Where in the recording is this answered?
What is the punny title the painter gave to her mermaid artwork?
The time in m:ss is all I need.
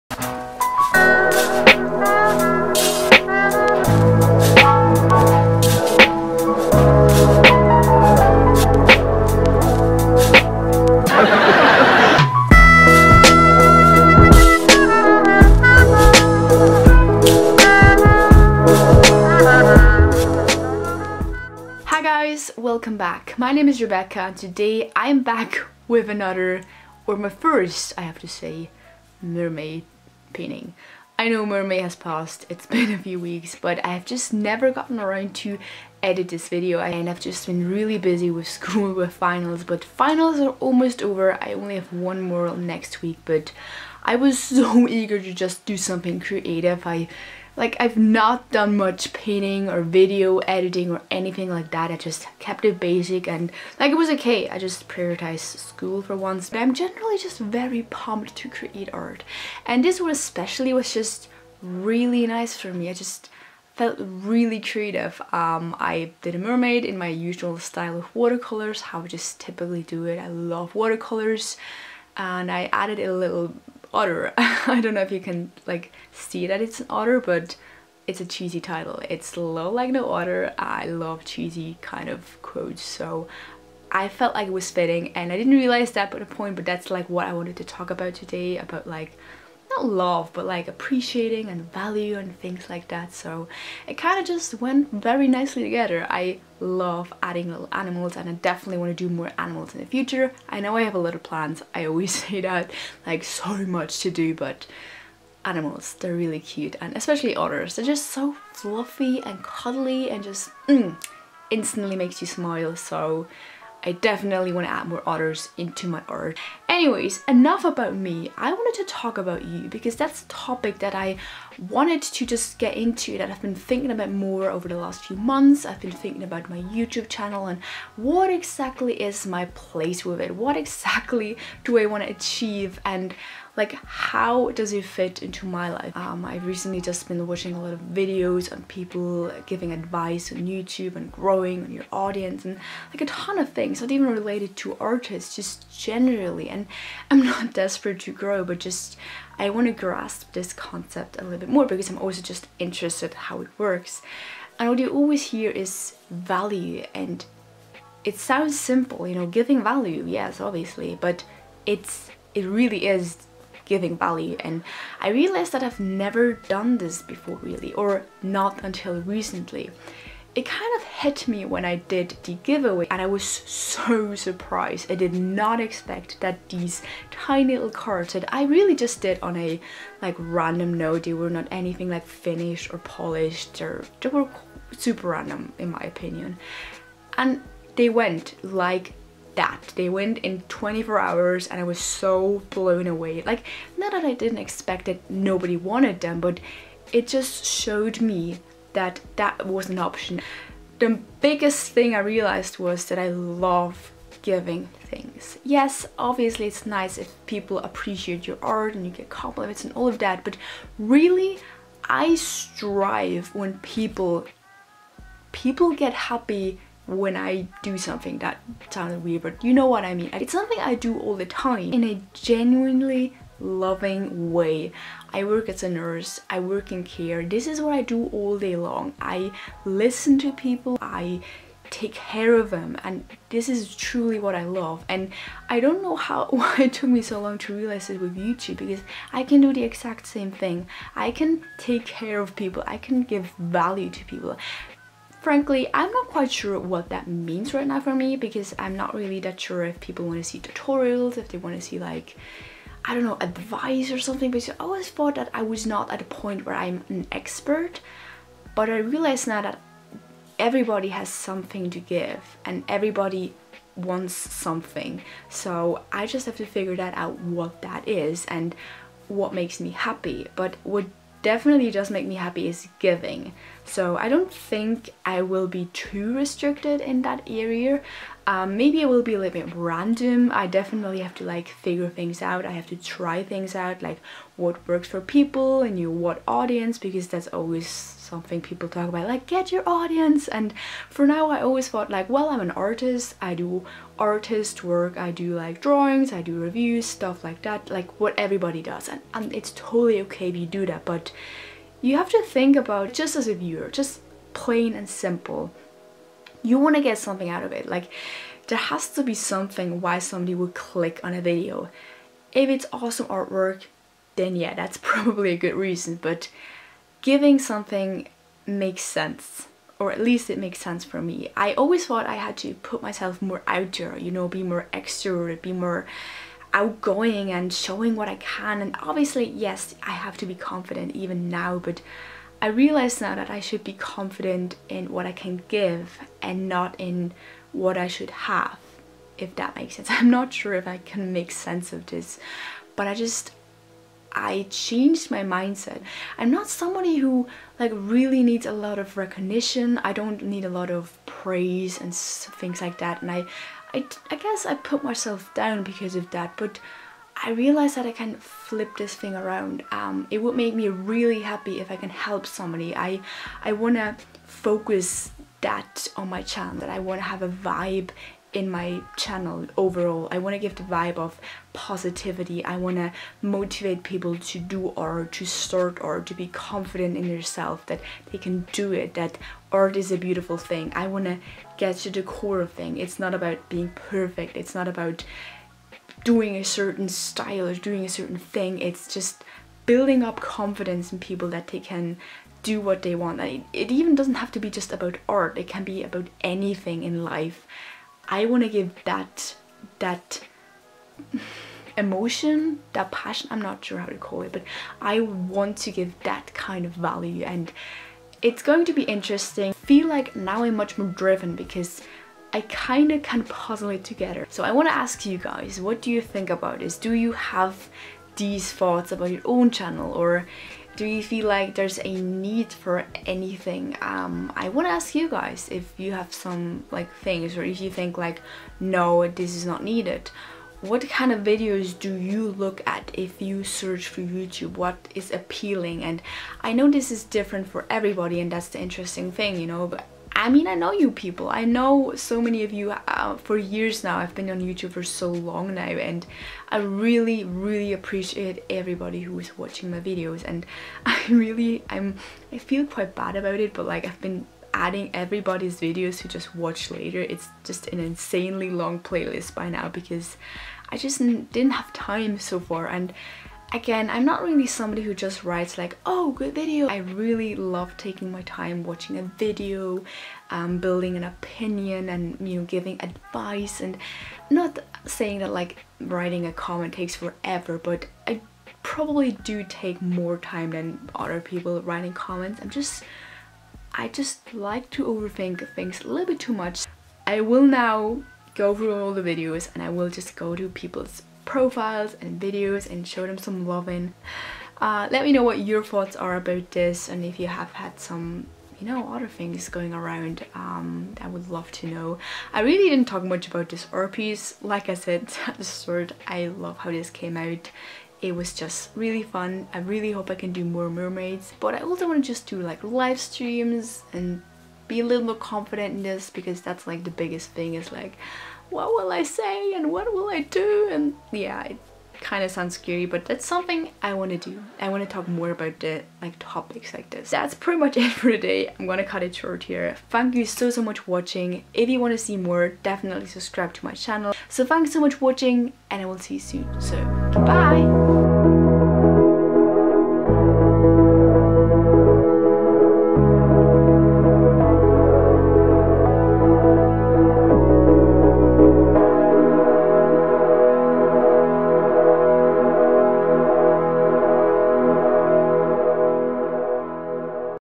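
1:19.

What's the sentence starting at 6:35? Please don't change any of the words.
It can be about anything in life.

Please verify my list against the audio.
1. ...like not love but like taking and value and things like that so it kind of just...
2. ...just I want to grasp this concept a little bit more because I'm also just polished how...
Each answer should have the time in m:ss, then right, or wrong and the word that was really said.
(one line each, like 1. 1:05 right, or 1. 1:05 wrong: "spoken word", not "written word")
1. 1:28 wrong: "appreciating", not "taking"
2. 2:28 wrong: "interested", not "polished".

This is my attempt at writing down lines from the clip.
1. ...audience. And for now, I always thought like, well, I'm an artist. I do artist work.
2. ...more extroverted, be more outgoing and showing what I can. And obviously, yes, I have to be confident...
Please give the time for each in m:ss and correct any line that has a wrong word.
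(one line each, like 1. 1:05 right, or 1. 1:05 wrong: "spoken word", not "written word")
1. 4:49 right
2. 5:24 right.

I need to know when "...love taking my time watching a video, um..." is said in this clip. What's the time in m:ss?
7:47.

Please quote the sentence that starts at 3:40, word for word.
It's something I do all the time in a genuinely loving way.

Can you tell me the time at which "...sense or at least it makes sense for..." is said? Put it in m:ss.
5:18.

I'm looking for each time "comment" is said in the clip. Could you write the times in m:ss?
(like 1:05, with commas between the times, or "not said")
7:56, 8:01.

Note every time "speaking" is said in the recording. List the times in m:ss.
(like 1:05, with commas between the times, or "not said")
not said.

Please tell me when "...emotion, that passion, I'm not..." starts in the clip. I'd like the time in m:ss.
6:41.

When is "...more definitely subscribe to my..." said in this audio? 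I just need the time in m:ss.
8:52.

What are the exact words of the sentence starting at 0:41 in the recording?
I only have one more next week, but I was so eager to just do something creative.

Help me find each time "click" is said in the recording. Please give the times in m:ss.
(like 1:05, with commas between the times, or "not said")
5:10.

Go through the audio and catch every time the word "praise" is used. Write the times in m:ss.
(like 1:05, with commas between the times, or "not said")
5:51.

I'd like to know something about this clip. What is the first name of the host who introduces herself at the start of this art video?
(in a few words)
Rebecca.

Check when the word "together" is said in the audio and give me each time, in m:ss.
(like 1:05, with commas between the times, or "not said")
1:35, 6:53.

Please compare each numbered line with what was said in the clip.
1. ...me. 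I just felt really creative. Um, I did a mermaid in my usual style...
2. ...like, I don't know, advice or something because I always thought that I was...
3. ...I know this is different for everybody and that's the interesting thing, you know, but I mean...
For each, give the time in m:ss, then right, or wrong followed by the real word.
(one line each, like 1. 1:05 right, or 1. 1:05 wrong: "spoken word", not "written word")
1. 1:02 right
2. 4:11 right
3. 7:16 right.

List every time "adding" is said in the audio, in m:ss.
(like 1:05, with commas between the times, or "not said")
1:37, 7:34.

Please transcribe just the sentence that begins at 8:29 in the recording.
I really hope I can do more mermaids.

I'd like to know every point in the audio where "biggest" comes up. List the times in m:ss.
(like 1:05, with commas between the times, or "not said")
3:21, 8:36.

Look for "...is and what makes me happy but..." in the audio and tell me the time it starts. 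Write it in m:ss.
4:27.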